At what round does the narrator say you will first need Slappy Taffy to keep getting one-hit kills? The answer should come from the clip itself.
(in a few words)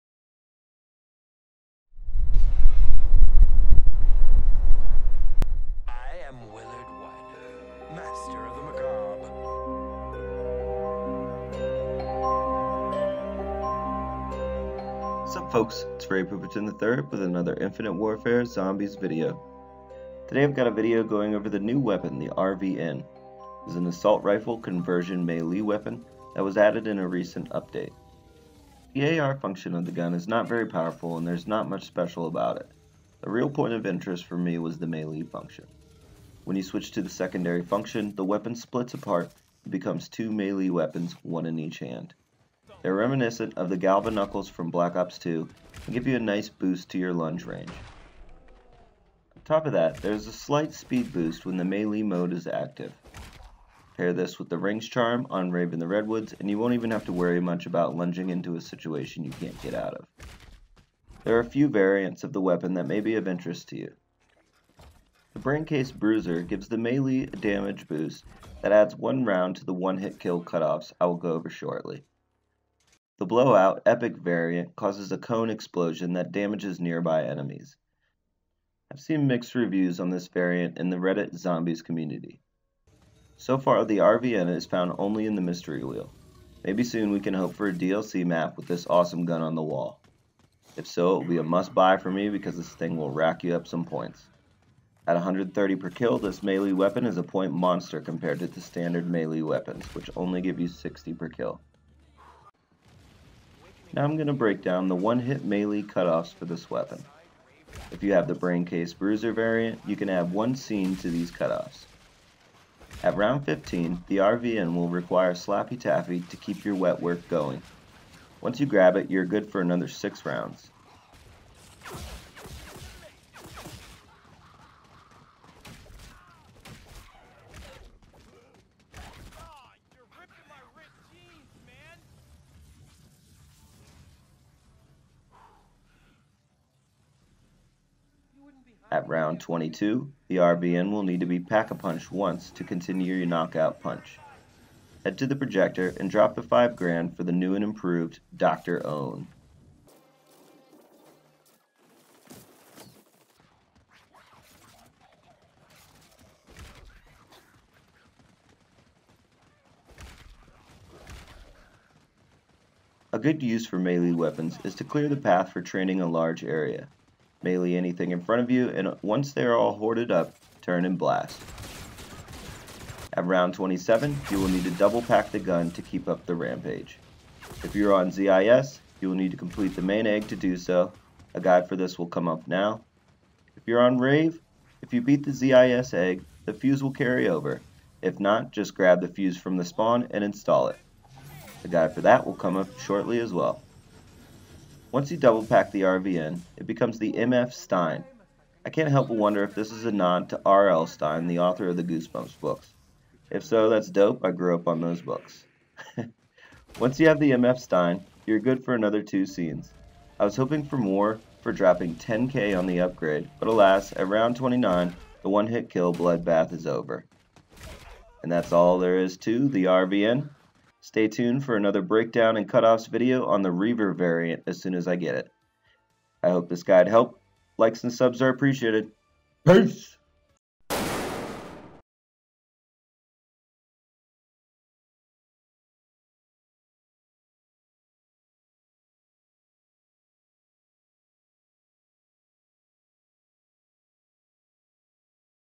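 15.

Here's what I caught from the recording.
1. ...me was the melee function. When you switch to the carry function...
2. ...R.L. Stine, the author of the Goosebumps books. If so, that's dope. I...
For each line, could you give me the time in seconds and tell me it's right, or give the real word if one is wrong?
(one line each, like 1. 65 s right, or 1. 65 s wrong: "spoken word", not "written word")
1. 34 s wrong: "secondary", not "carry"
2. 200 s right.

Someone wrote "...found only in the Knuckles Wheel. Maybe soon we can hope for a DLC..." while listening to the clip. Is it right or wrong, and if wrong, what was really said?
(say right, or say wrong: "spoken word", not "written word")
wrong: "Mystery", not "Knuckles".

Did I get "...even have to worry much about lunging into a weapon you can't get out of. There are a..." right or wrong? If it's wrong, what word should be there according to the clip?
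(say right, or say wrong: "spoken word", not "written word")
wrong: "situation", not "weapon".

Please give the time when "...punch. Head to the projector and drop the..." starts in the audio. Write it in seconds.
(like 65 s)
143 s.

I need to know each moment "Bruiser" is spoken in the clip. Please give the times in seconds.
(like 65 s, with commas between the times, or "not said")
65 s, 108 s.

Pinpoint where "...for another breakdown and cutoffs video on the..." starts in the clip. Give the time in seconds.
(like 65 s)
221 s.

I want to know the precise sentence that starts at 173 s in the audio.
At round 27, you will need to double pack the gun to keep up the rampage.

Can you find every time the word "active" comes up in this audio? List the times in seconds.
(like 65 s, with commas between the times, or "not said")
52 s.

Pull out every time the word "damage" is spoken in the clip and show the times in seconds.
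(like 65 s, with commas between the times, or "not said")
67 s, 76 s.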